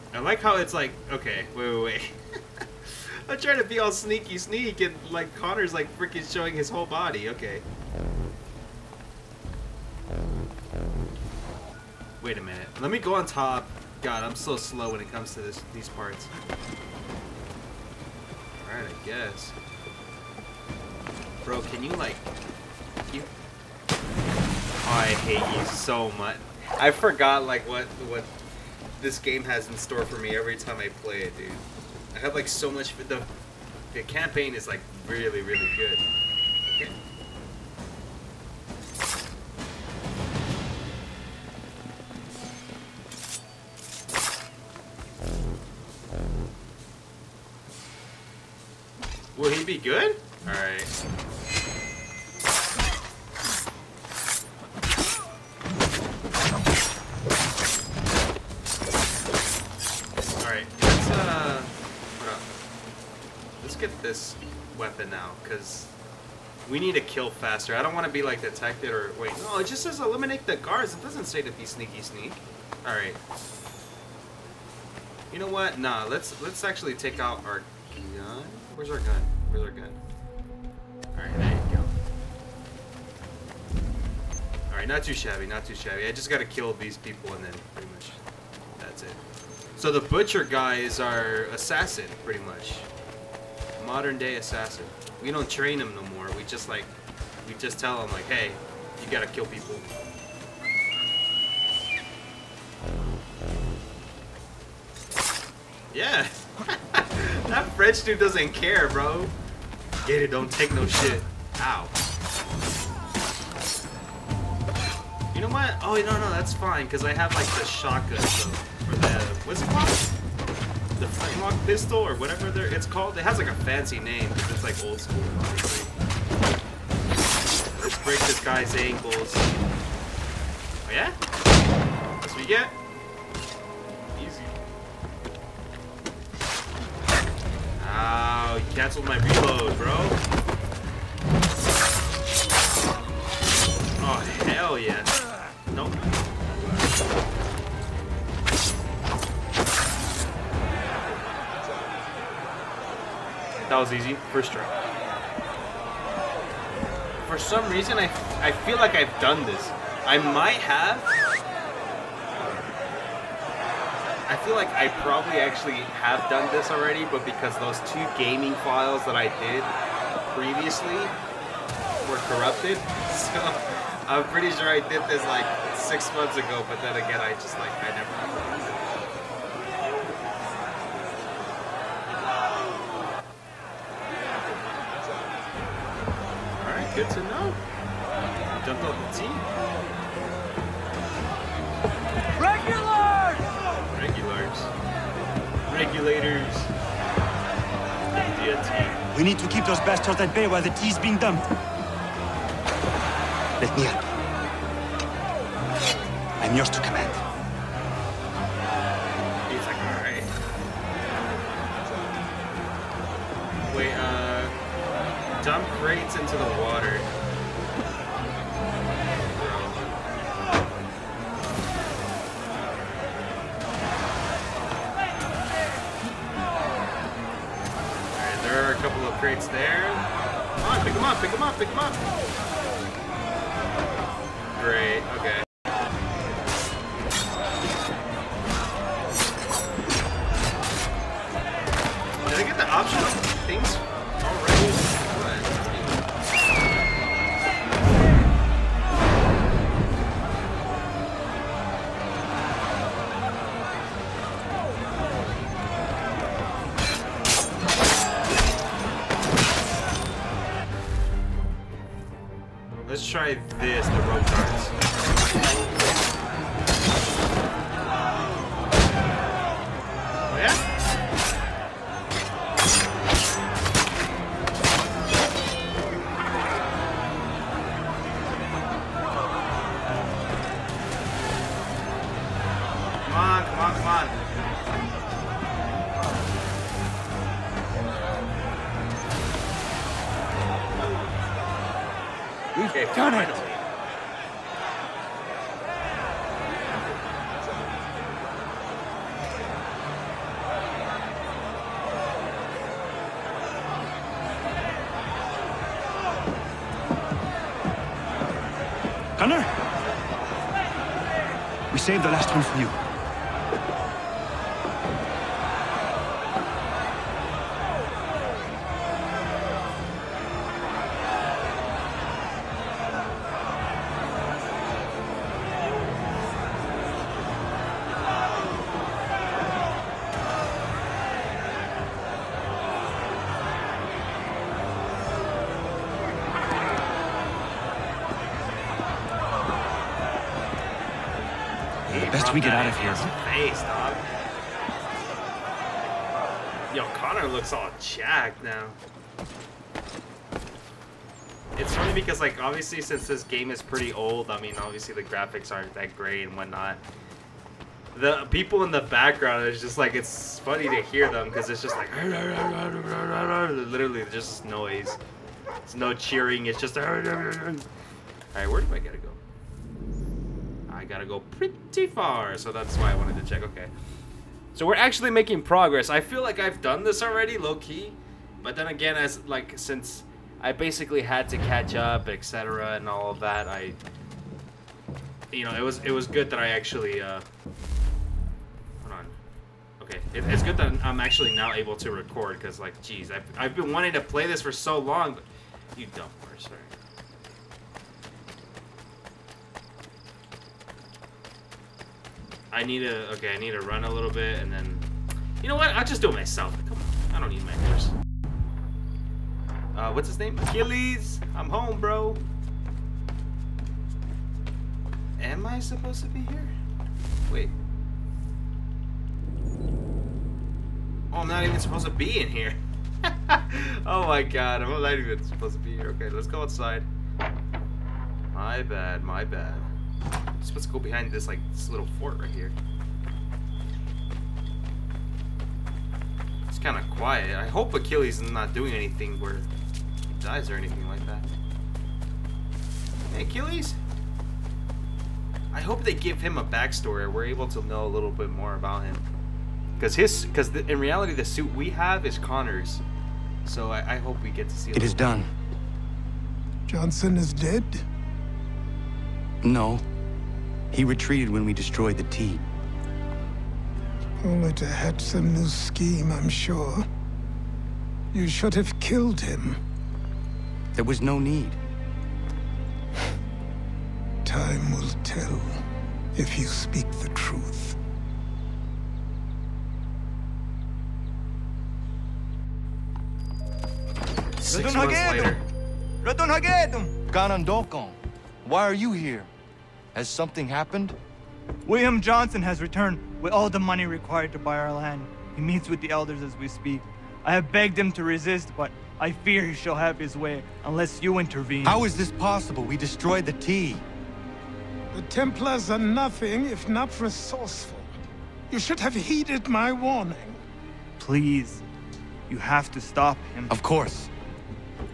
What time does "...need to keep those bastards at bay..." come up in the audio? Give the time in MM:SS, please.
03:19.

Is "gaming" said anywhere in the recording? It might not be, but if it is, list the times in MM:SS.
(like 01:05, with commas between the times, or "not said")
02:48.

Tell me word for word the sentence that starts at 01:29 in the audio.
So the butcher guy is our assassin, pretty much modern day assassin.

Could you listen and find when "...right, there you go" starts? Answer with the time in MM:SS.
01:21.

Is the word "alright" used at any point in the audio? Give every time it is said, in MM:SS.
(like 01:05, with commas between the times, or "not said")
00:18, 06:06.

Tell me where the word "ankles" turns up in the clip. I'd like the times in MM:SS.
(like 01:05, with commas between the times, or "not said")
02:08.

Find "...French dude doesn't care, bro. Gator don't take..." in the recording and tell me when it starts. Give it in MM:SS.
01:47.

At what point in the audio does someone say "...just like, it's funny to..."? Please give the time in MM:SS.
05:59.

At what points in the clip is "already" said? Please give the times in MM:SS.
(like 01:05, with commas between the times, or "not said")
02:46, 06:17.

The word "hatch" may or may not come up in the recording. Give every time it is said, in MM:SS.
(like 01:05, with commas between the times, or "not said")
07:44.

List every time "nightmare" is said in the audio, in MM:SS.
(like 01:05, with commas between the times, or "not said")
not said.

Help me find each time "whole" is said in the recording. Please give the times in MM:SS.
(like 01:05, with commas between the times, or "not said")
00:06.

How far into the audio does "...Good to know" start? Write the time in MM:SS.
03:06.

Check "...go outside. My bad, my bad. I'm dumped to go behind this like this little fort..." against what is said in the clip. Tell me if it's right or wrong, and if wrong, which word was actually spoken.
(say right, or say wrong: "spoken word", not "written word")
wrong: "supposed", not "dumped".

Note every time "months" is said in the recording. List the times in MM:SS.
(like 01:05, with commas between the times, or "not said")
02:56, 08:04.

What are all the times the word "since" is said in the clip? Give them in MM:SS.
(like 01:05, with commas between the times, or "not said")
05:52, 06:19.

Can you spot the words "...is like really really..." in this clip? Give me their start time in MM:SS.
00:34.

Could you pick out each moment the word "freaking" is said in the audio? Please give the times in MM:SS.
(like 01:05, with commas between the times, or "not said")
00:05.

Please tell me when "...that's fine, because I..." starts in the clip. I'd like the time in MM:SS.
01:56.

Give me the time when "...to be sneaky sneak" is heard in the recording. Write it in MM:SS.
01:11.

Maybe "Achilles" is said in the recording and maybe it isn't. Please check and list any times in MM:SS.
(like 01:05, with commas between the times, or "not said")
06:50, 07:17, 07:23.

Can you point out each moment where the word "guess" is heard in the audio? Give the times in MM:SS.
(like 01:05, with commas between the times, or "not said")
00:19.